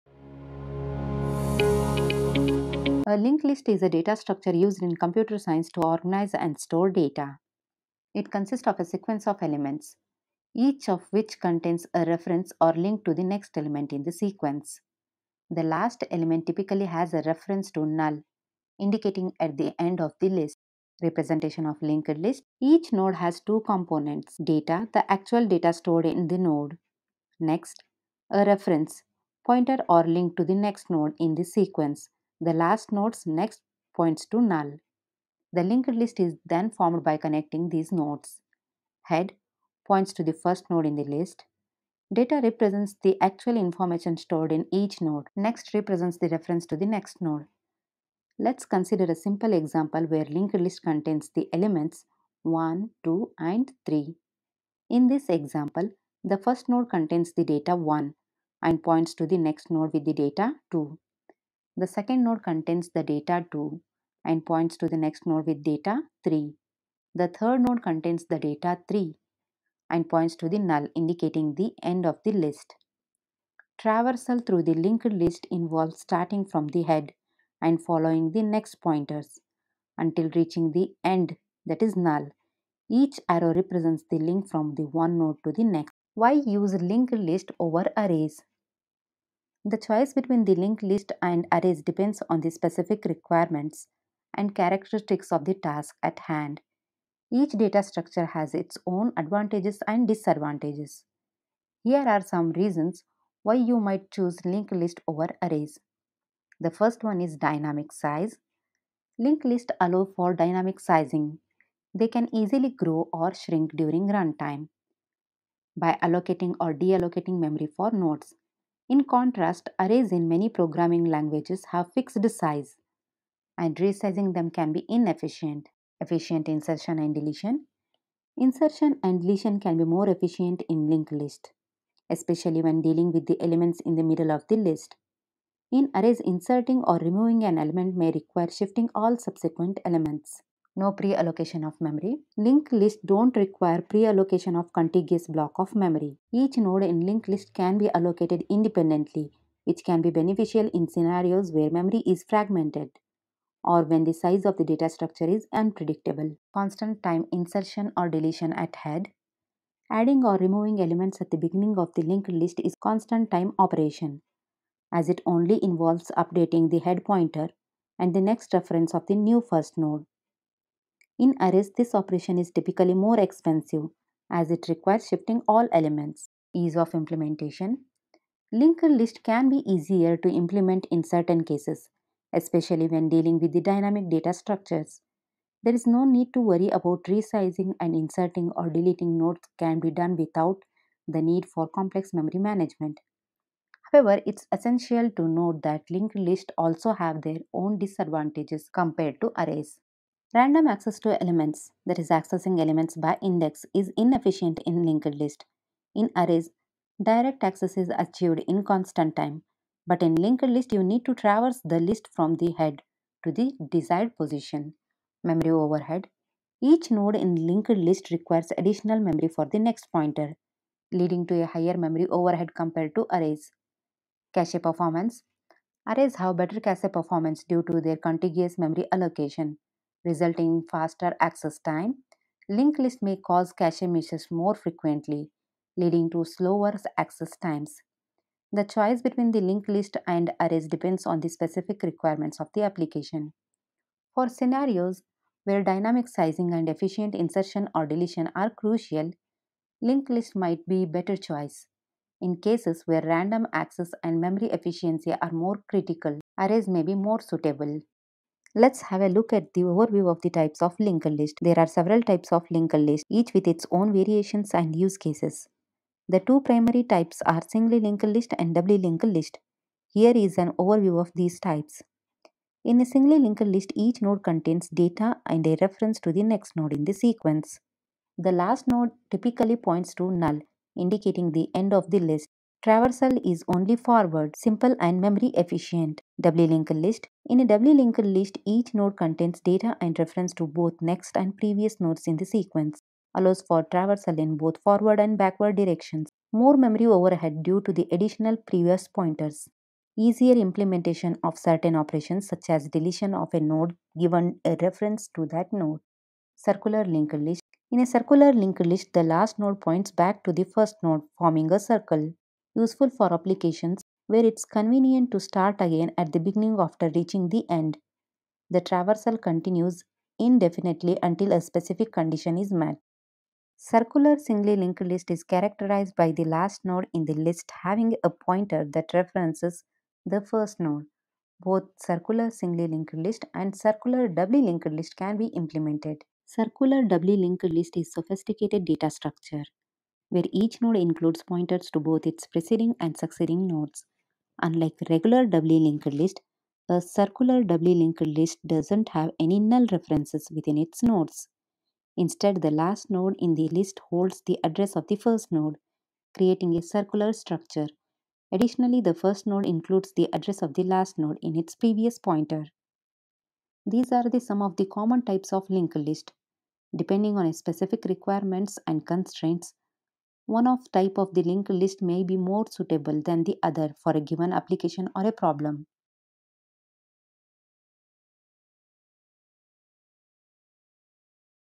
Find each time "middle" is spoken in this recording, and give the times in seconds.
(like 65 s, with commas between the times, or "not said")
134 s.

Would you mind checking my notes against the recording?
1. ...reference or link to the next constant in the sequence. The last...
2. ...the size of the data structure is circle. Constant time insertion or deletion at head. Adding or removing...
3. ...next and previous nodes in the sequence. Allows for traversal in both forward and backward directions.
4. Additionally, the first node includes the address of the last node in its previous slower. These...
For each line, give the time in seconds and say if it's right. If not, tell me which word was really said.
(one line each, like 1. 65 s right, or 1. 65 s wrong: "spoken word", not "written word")
1. 12 s wrong: "element", not "constant"
2. 154 s wrong: "unpredictable", not "circle"
3. 290 s right
4. 358 s wrong: "pointer", not "slower".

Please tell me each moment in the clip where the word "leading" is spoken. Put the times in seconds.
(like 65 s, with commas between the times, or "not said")
220 s, 235 s.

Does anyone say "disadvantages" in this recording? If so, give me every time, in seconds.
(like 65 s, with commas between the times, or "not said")
100 s, 197 s.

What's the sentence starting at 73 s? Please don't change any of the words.
Traversal through the linked list involves starting from the head and following the next pointers until reaching the end that is null.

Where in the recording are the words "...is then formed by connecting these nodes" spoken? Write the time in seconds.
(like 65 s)
36 s.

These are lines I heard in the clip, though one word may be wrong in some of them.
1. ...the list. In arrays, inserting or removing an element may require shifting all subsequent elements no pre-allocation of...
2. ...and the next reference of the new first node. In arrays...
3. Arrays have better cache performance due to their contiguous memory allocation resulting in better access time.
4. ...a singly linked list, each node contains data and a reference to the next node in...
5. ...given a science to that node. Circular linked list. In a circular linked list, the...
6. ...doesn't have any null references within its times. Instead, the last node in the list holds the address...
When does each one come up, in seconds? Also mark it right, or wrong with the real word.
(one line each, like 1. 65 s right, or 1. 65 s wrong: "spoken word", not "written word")
1. 134 s right
2. 167 s right
3. 225 s wrong: "faster", not "better"
4. 272 s right
5. 303 s wrong: "reference", not "science"
6. 348 s wrong: "nodes", not "times".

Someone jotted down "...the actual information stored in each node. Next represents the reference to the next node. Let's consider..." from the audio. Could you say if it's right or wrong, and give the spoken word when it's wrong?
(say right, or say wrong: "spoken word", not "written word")
right.